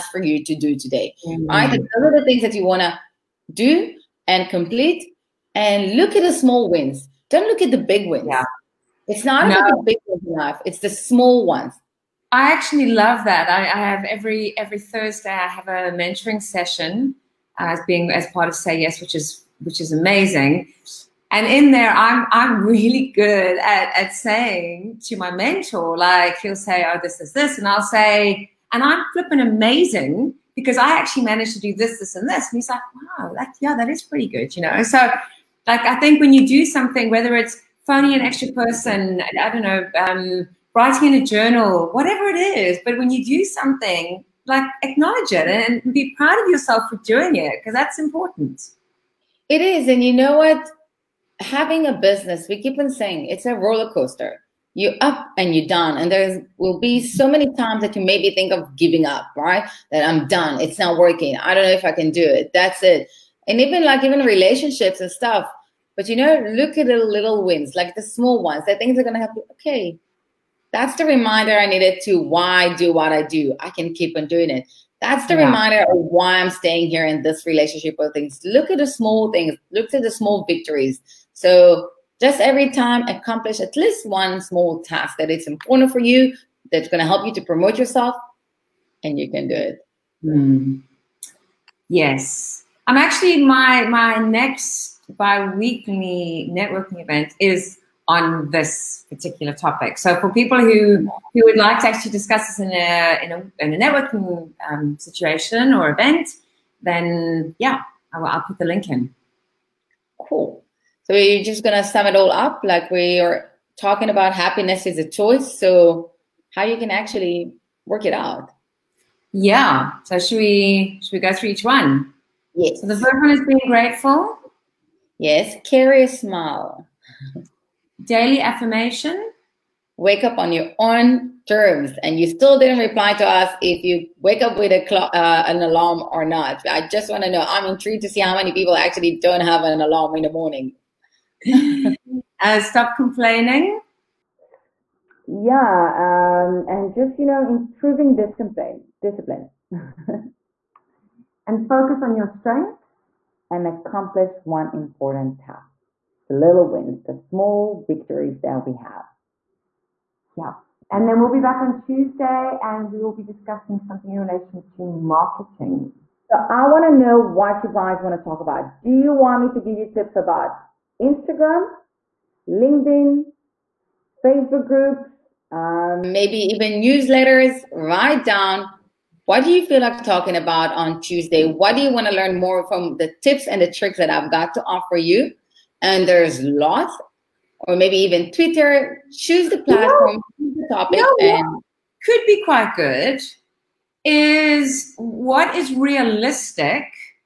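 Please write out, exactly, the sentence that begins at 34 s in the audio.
So, like, I think when you do something, whether it's phoning an extra person, I don't know.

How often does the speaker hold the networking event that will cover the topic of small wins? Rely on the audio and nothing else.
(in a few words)
Bi-weekly.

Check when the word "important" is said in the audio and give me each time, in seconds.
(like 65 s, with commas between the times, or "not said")
47 s, 85 s, 154 s.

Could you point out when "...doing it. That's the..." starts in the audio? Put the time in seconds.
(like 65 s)
74 s.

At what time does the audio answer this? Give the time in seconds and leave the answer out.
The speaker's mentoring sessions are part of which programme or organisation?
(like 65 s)
18 s.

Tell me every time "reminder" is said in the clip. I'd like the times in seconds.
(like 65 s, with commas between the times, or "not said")
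71 s, 75 s.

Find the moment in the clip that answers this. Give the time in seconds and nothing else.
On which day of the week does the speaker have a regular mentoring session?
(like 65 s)
14 s.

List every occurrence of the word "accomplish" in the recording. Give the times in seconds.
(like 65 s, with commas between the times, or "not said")
83 s, 153 s.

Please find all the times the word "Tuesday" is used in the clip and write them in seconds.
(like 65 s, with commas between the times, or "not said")
161 s, 180 s.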